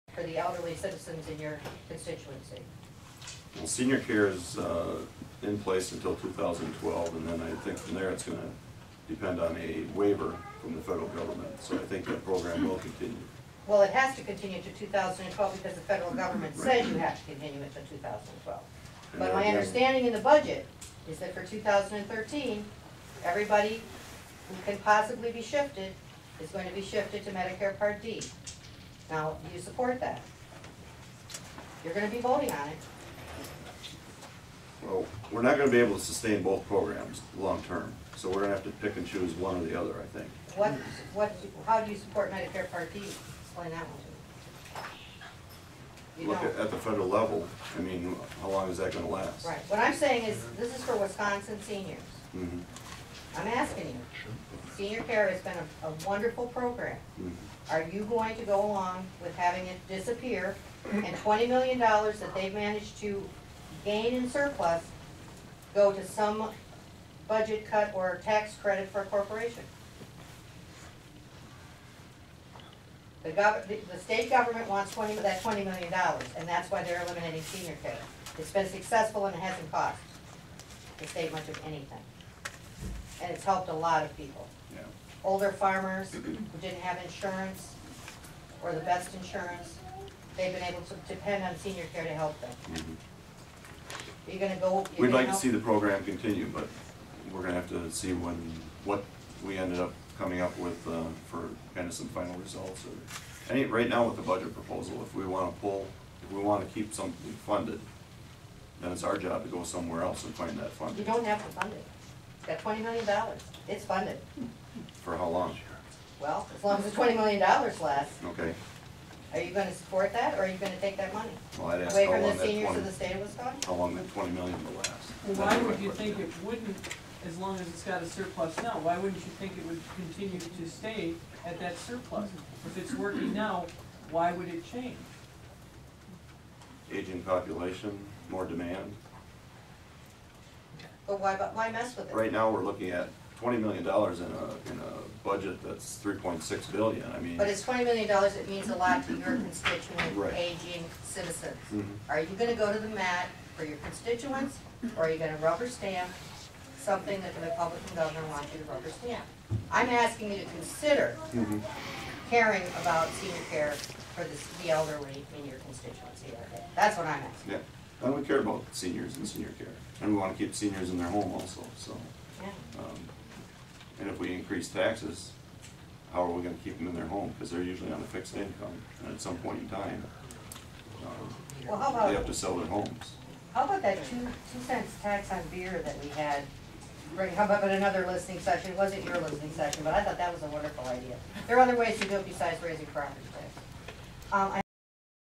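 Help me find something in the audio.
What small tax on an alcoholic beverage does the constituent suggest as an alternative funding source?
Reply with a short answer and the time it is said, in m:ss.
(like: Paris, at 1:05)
2 cents tax on beer, at 3:04.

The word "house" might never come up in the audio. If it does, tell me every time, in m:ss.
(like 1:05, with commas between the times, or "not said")
not said.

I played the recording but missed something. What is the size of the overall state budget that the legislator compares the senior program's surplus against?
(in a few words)
3.6 billion dollars.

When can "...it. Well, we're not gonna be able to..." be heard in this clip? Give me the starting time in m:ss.
0:32.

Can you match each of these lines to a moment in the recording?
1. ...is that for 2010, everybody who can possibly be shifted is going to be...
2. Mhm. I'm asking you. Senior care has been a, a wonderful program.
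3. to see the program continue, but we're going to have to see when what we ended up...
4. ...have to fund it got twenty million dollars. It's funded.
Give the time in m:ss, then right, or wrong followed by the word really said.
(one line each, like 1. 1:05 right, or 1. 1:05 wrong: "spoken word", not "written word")
1. 0:21 wrong: "2013", not "2010"
2. 0:52 right
3. 1:35 right
4. 1:51 right.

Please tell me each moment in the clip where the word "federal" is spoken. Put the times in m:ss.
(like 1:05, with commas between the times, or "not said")
0:10, 0:15, 0:46.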